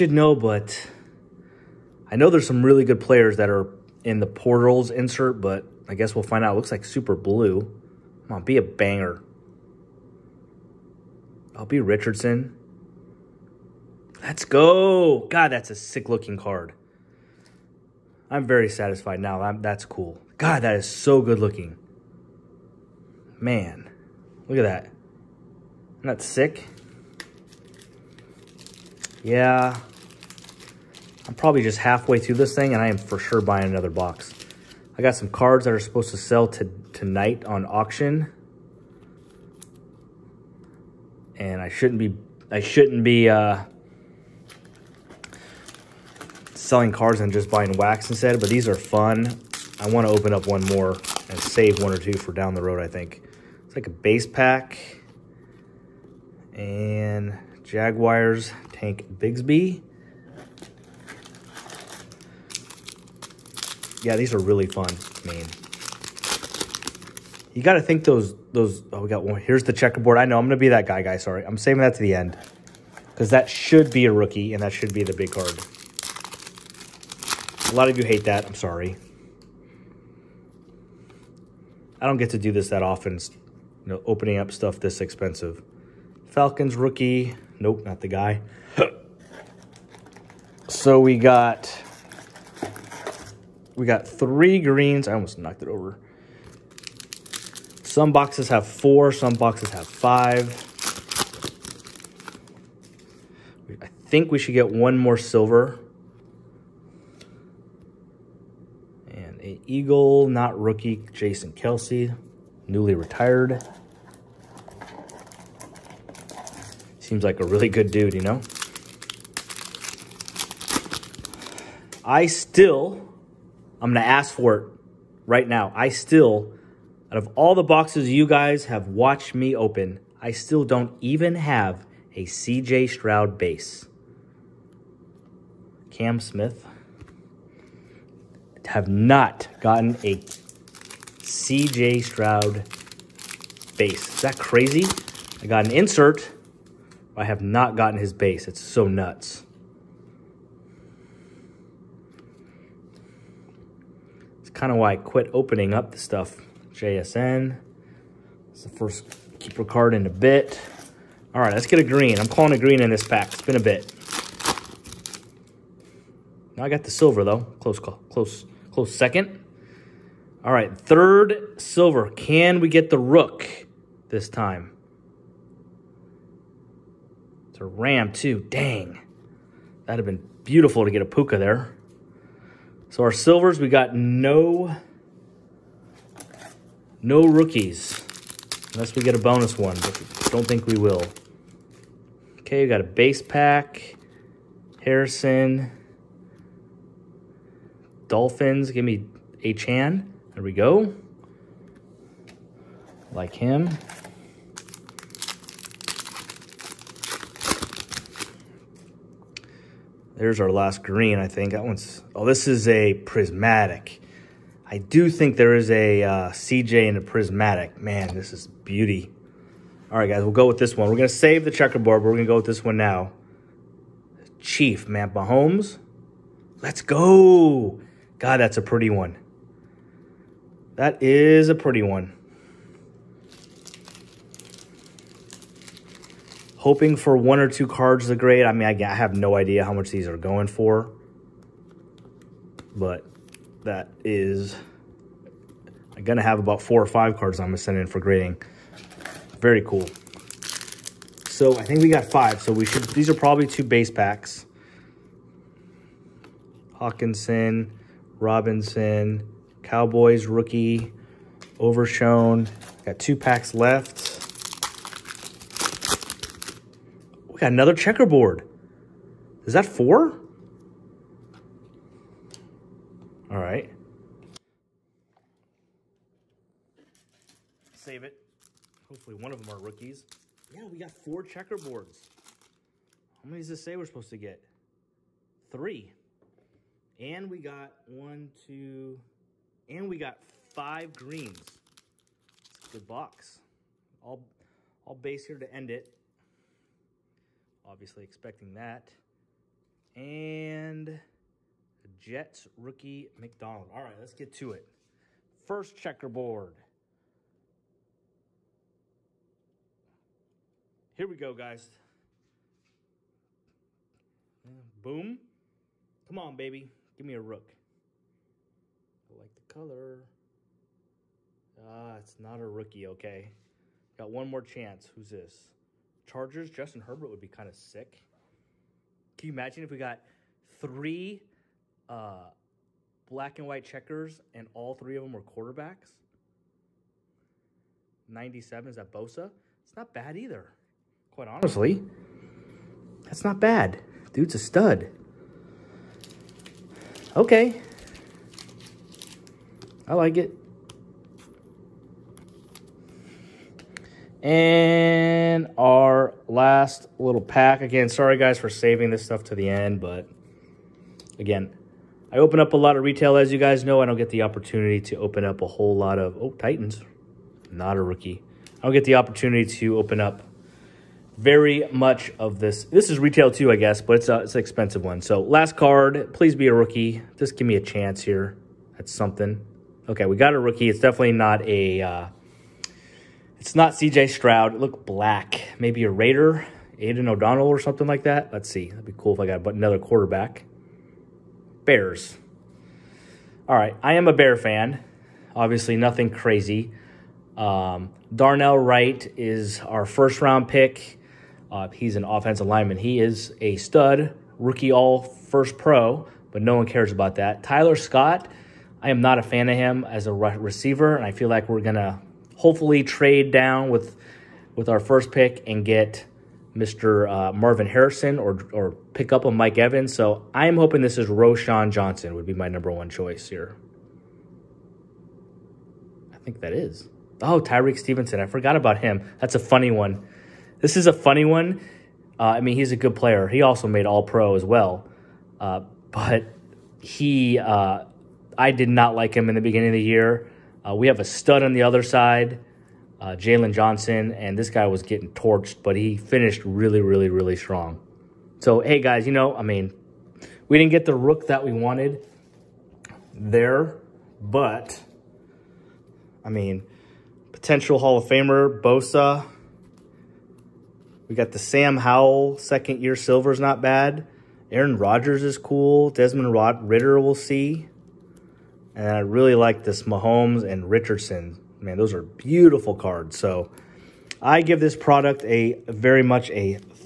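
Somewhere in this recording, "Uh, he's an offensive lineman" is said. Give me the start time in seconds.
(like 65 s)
401 s.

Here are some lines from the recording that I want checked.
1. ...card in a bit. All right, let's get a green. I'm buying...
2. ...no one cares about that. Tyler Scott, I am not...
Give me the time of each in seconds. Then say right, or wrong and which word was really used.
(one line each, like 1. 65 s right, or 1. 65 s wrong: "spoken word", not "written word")
1. 159 s wrong: "calling", not "buying"
2. 406 s right.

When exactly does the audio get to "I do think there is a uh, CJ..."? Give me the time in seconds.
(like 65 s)
214 s.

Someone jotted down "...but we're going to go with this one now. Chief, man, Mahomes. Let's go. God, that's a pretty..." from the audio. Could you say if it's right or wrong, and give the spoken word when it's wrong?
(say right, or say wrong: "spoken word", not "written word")
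right.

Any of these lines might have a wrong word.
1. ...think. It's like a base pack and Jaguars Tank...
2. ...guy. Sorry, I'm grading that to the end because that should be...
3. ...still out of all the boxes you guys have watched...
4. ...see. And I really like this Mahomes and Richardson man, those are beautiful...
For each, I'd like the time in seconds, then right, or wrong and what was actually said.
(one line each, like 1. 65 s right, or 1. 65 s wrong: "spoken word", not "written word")
1. 52 s right
2. 71 s wrong: "saving", not "grading"
3. 125 s right
4. 467 s right.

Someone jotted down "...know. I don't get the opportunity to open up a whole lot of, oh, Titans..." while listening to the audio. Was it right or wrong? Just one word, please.
right.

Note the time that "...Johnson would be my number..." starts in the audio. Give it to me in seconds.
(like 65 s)
421 s.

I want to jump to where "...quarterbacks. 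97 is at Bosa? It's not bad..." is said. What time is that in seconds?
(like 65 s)
335 s.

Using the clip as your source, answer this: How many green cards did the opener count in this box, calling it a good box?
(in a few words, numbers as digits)
5.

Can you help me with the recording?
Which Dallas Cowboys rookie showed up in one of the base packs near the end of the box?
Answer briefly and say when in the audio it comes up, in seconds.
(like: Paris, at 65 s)
Overshown, at 261 s.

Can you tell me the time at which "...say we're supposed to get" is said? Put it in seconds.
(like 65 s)
283 s.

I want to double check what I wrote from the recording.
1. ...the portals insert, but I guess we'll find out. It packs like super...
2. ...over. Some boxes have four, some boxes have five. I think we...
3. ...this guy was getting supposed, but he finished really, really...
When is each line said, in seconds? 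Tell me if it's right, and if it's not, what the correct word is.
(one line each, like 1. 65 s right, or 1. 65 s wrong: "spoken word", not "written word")
1. 4 s wrong: "looks", not "packs"
2. 95 s right
3. 444 s wrong: "torched", not "supposed".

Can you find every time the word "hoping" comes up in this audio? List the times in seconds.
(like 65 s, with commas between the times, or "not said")
236 s, 420 s.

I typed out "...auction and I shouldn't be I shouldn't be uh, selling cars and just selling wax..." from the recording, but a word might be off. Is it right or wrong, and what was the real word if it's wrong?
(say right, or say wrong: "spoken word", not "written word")
wrong: "buying", not "selling".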